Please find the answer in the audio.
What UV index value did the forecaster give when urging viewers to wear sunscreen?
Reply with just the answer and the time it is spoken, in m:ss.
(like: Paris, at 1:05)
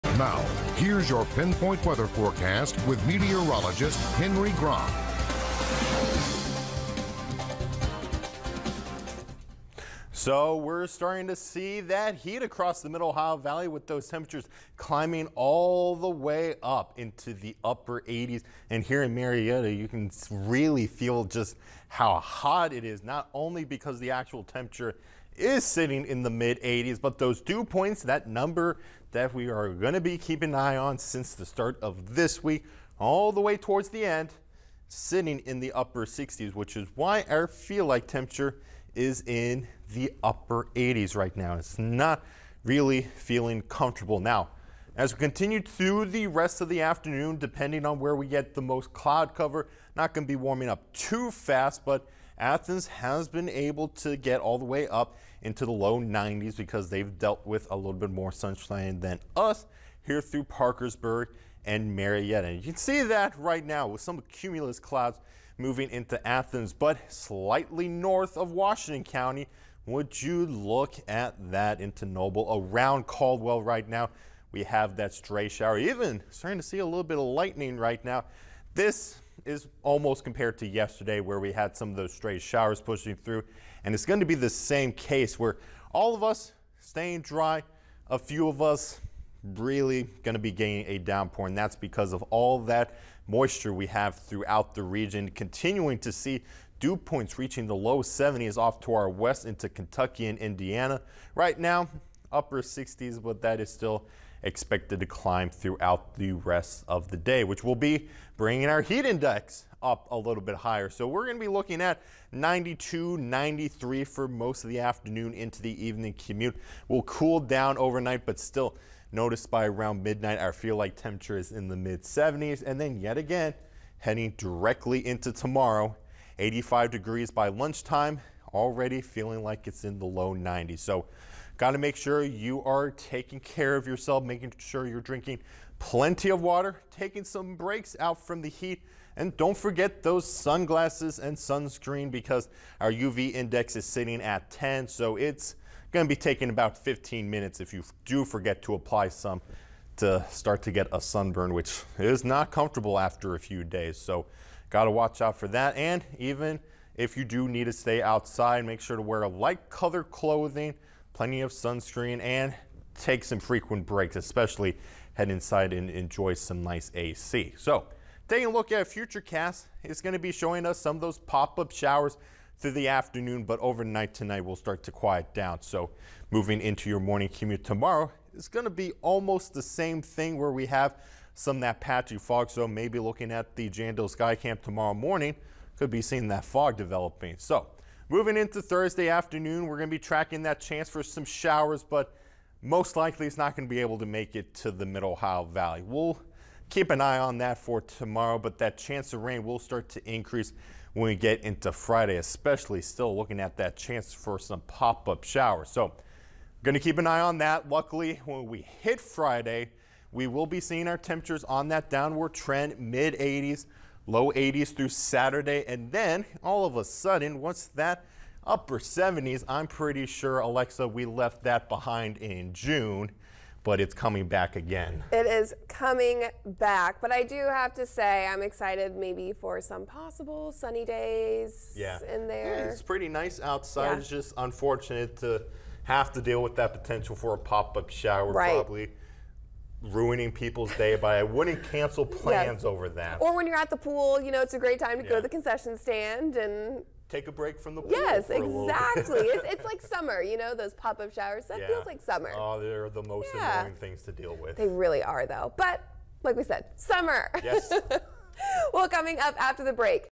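10, at 2:24.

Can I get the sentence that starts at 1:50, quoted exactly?
So we're going to be looking at 92, 93 for most of the afternoon into the evening commute.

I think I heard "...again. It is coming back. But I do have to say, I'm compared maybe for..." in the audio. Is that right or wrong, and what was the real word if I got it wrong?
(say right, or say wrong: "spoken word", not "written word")
wrong: "excited", not "compared".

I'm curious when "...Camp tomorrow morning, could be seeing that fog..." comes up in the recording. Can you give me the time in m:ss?
3:04.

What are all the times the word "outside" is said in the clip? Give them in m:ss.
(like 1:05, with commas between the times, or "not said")
2:38, 3:53.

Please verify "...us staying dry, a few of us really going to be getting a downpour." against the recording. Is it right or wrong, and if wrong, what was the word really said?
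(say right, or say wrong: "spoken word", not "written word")
right.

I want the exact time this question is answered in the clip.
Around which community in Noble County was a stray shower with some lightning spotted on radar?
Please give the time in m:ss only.
1:13.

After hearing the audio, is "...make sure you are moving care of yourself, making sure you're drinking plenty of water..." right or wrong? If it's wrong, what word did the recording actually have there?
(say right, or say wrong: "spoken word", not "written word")
wrong: "taking", not "moving".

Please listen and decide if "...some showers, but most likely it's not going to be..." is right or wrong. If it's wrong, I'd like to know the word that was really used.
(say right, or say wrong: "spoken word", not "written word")
right.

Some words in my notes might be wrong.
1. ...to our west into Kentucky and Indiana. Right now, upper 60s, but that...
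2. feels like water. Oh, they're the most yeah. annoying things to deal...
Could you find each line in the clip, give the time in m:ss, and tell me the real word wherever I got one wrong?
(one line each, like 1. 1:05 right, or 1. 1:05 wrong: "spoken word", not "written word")
1. 1:38 right
2. 4:11 wrong: "summer", not "water".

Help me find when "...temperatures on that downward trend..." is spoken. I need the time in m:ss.
3:30.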